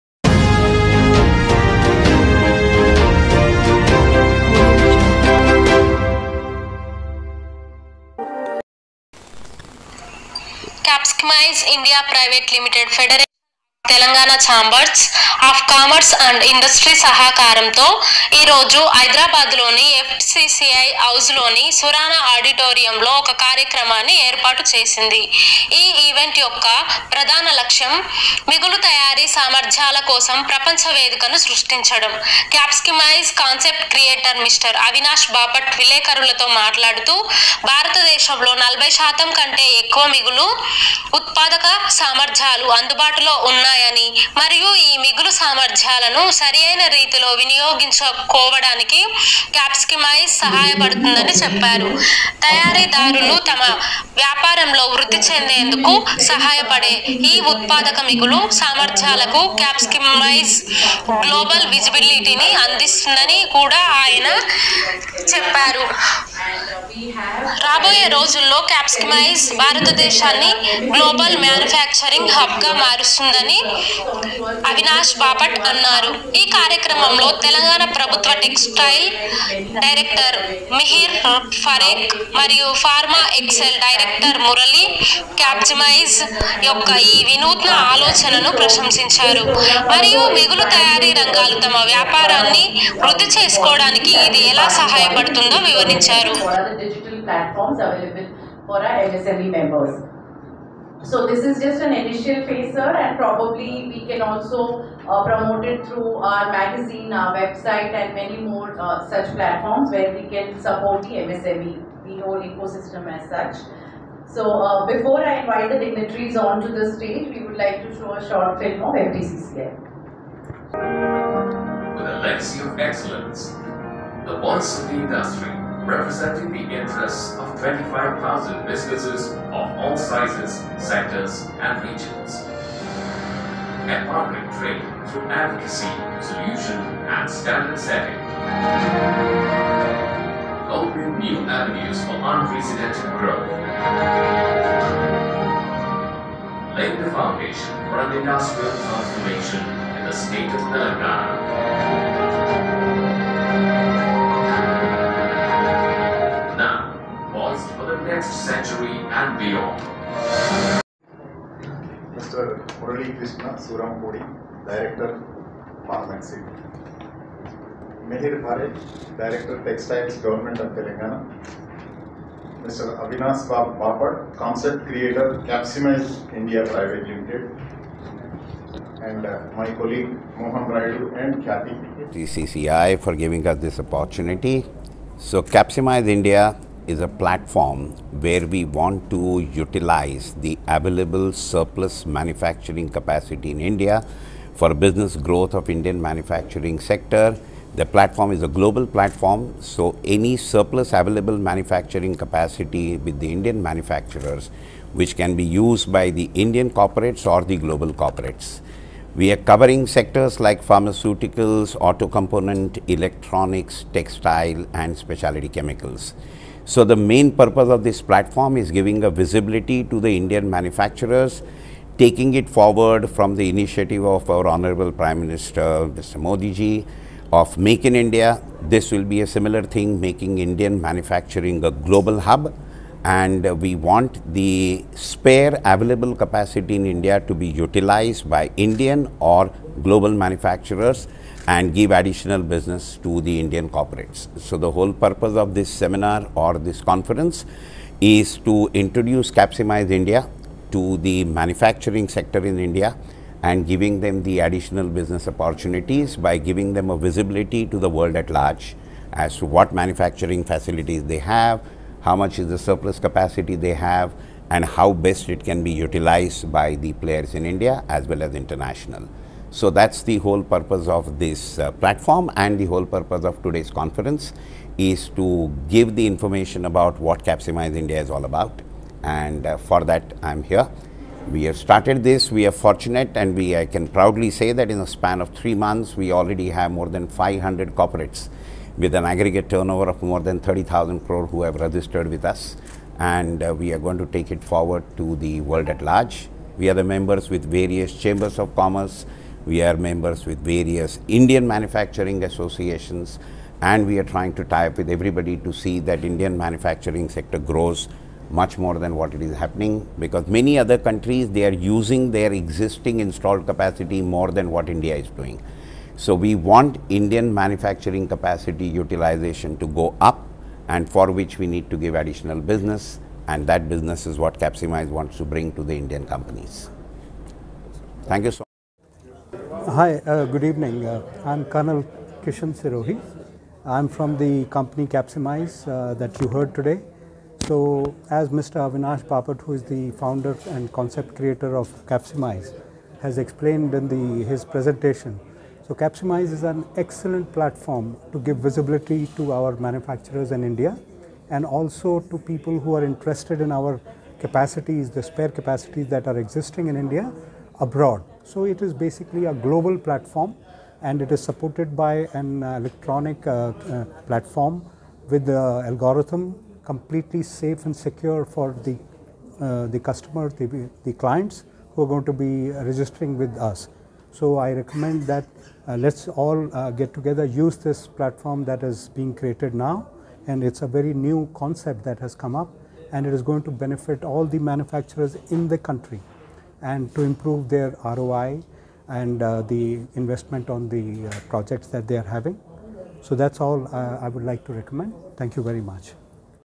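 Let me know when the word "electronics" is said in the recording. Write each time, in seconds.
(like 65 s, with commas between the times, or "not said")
212 s, 362 s.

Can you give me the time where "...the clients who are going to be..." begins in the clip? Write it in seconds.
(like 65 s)
370 s.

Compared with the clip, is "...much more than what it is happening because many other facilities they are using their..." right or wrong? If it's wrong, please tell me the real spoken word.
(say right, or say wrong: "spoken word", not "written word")
wrong: "countries", not "facilities".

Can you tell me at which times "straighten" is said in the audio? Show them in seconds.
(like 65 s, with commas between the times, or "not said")
not said.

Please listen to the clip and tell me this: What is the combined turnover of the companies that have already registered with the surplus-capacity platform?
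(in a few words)
more than 30,000 crore.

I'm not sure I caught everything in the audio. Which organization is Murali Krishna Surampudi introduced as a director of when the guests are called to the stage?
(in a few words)
Pharmexcil.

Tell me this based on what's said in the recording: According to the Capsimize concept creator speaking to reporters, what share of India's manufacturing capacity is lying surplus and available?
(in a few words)
more than 40%.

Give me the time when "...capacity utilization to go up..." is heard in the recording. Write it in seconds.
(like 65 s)
318 s.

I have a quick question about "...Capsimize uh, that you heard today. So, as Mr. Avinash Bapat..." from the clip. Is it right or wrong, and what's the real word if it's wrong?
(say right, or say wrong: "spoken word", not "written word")
right.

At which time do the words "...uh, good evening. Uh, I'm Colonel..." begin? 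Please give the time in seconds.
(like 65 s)
330 s.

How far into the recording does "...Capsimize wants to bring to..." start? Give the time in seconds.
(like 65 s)
324 s.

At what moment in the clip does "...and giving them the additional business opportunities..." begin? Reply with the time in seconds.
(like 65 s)
253 s.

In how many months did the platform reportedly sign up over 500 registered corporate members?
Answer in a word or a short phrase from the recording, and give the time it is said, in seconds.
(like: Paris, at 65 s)
3 months, at 285 s.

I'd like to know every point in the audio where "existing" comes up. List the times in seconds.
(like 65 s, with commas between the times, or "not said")
312 s, 356 s.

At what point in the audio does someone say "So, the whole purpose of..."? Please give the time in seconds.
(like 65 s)
244 s.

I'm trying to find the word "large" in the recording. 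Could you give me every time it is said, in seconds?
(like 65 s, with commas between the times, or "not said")
258 s, 295 s.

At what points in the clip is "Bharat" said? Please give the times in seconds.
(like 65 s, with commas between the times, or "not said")
168 s.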